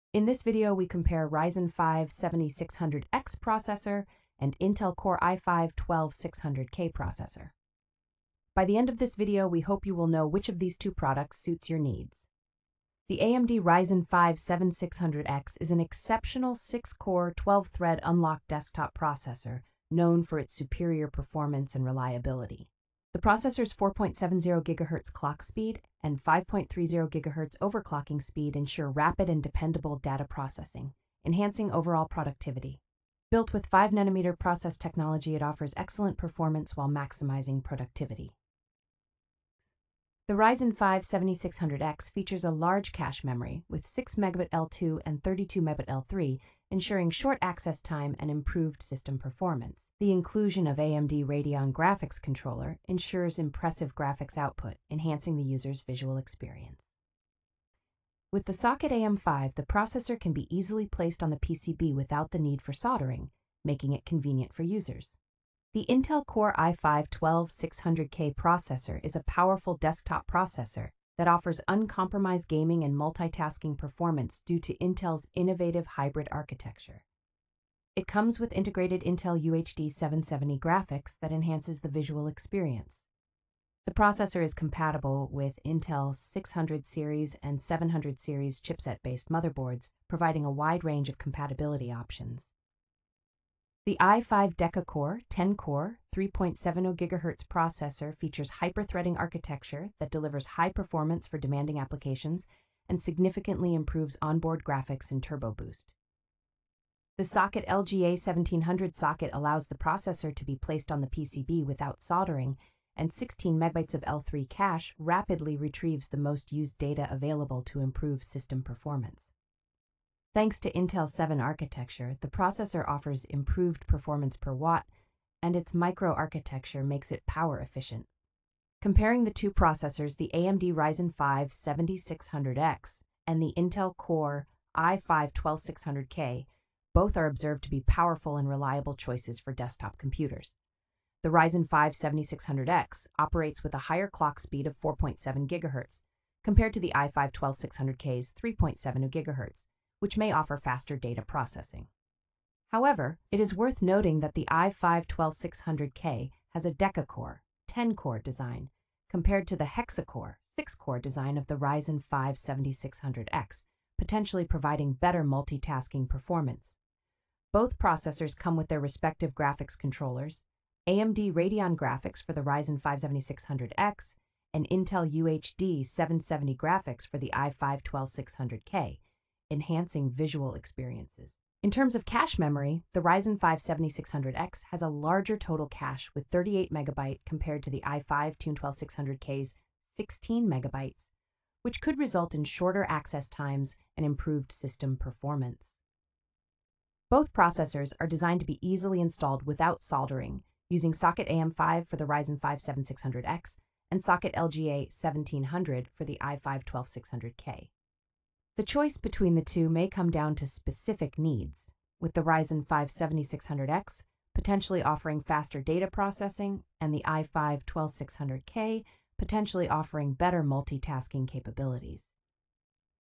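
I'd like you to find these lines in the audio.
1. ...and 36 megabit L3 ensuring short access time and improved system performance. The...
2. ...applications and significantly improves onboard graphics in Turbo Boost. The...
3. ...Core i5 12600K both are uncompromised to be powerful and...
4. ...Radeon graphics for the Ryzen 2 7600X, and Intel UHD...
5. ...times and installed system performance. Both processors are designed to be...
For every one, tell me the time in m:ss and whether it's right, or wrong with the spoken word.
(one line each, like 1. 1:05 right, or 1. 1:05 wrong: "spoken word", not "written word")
1. 0:45 wrong: "32", not "36"
2. 1:41 right
3. 2:13 wrong: "observed", not "uncompromised"
4. 2:51 wrong: "5", not "2"
5. 3:13 wrong: "improved", not "installed".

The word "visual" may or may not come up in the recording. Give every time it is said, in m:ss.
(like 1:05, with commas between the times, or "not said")
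0:55, 1:21, 3:00.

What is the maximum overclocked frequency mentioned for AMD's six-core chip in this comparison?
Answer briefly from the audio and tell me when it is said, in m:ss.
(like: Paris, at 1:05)
5.30 GHz, at 0:26.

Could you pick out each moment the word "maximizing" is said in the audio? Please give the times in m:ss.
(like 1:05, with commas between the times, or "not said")
0:36.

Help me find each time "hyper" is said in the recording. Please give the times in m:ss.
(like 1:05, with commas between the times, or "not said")
1:38.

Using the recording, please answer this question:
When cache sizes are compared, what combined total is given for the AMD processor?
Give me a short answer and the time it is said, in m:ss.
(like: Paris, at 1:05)
38 MB, at 3:06.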